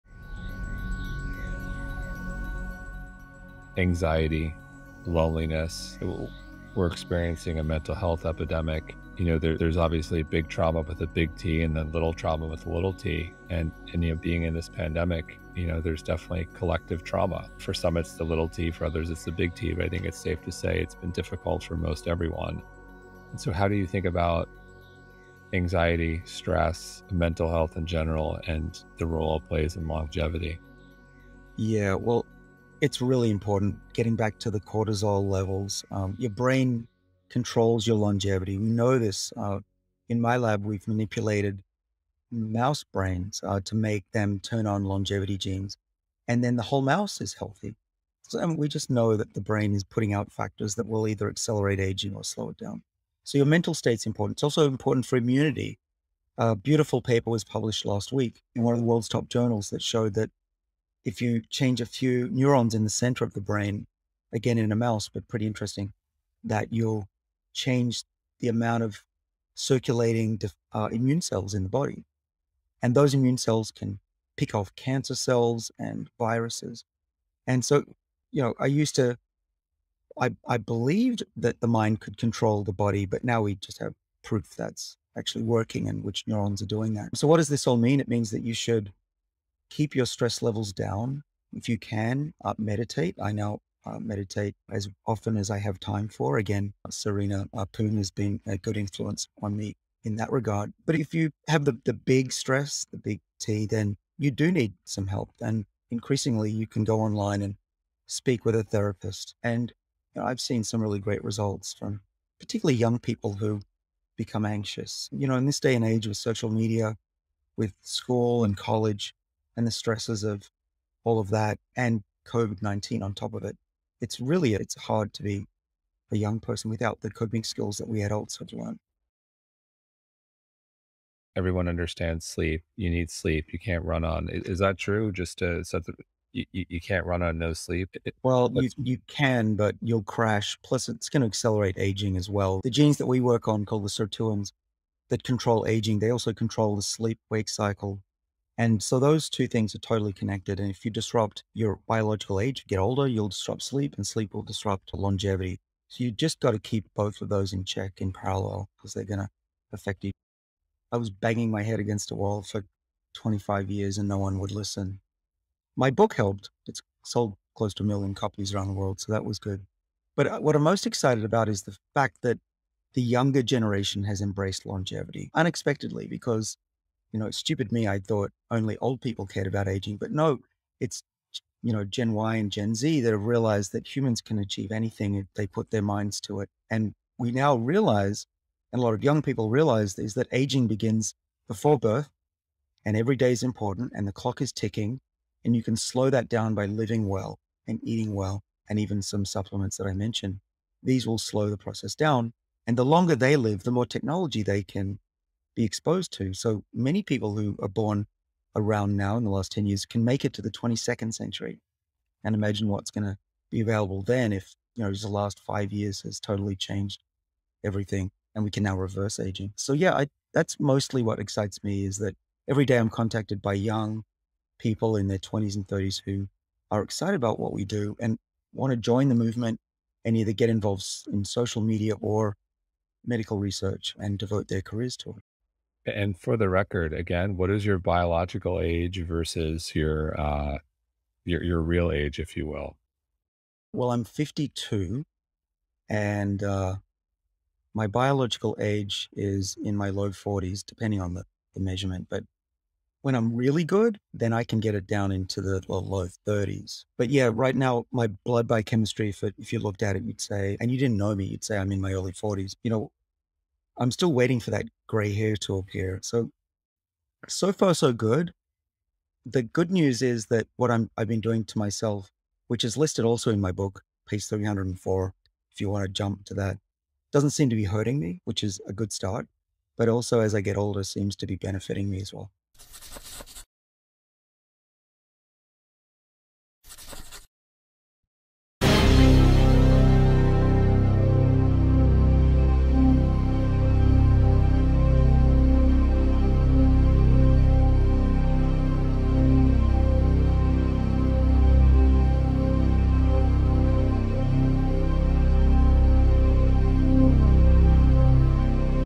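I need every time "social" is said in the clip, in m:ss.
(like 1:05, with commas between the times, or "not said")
1:56, 3:51.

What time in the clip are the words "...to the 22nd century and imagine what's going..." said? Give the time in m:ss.
3:30.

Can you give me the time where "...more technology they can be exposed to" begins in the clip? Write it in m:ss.
3:23.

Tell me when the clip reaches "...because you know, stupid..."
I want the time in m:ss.
2:56.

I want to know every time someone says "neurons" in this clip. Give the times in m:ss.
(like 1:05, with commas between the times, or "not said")
1:02, 1:26.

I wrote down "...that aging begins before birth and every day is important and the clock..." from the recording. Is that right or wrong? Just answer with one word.
right.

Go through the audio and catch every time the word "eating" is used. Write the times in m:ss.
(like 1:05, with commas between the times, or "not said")
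3:17.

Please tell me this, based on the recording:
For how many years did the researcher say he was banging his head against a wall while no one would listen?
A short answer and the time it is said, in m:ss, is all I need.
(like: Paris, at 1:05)
25 years, at 2:43.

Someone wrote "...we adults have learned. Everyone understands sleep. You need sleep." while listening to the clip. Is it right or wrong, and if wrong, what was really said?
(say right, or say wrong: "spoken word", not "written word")
right.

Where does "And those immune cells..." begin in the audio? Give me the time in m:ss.
1:12.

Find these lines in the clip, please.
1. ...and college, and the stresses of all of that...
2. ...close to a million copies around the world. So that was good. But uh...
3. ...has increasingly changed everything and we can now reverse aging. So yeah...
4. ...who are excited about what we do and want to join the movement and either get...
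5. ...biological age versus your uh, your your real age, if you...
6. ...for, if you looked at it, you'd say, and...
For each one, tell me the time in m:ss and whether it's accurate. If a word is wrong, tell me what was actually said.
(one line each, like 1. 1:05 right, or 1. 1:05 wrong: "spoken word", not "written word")
1. 1:58 right
2. 2:47 right
3. 3:36 wrong: "totally", not "increasingly"
4. 3:46 right
5. 3:57 right
6. 4:19 right.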